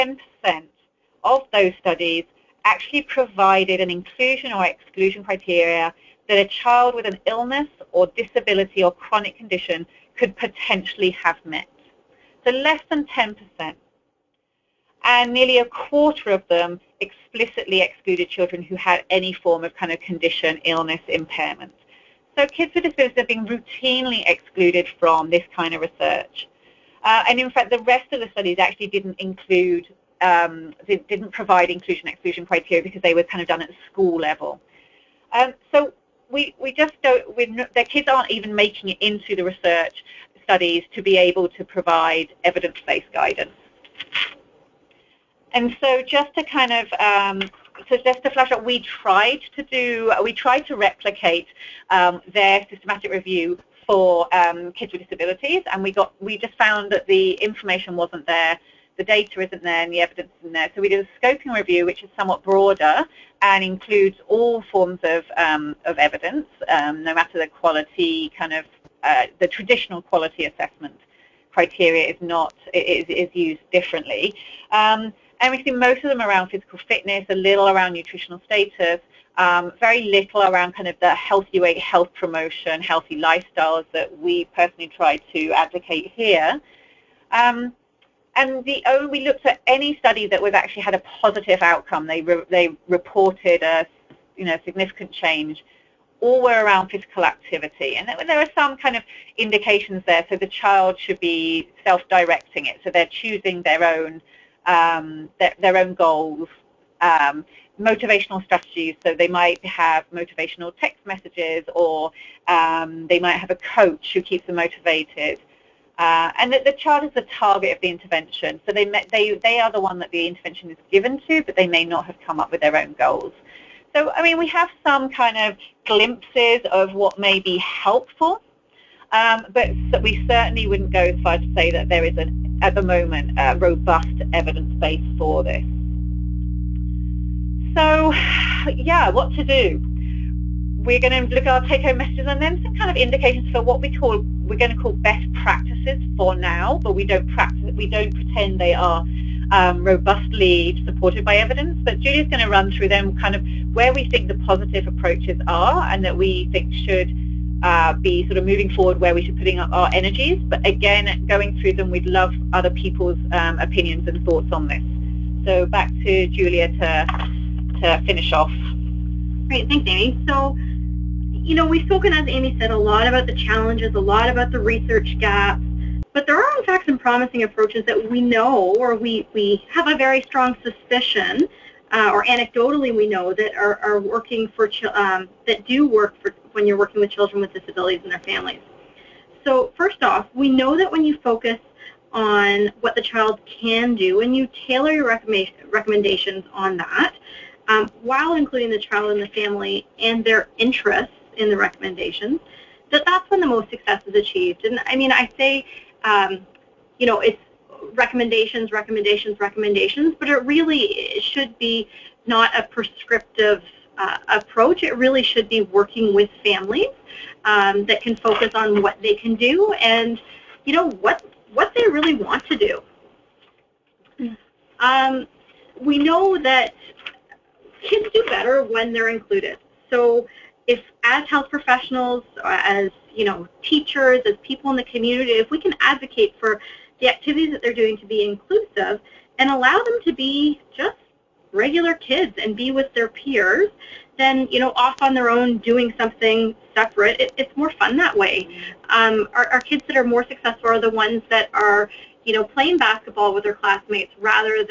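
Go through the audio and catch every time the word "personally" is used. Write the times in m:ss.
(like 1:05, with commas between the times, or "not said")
1:24.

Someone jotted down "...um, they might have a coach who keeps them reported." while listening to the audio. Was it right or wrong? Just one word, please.
wrong.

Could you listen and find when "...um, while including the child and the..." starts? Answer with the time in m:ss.
3:17.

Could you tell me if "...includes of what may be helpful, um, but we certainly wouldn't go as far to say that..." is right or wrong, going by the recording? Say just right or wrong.
wrong.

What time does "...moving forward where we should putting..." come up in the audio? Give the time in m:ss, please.
2:38.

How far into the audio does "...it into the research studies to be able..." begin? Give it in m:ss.
0:38.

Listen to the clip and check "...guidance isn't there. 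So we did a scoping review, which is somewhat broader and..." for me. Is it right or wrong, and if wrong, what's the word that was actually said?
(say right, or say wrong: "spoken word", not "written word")
wrong: "evidence", not "guidance".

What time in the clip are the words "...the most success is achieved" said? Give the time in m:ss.
3:23.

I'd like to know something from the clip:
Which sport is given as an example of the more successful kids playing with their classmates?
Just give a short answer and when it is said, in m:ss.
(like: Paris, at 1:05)
basketball, at 4:12.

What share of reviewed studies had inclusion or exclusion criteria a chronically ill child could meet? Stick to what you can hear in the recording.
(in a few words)
less than 10%.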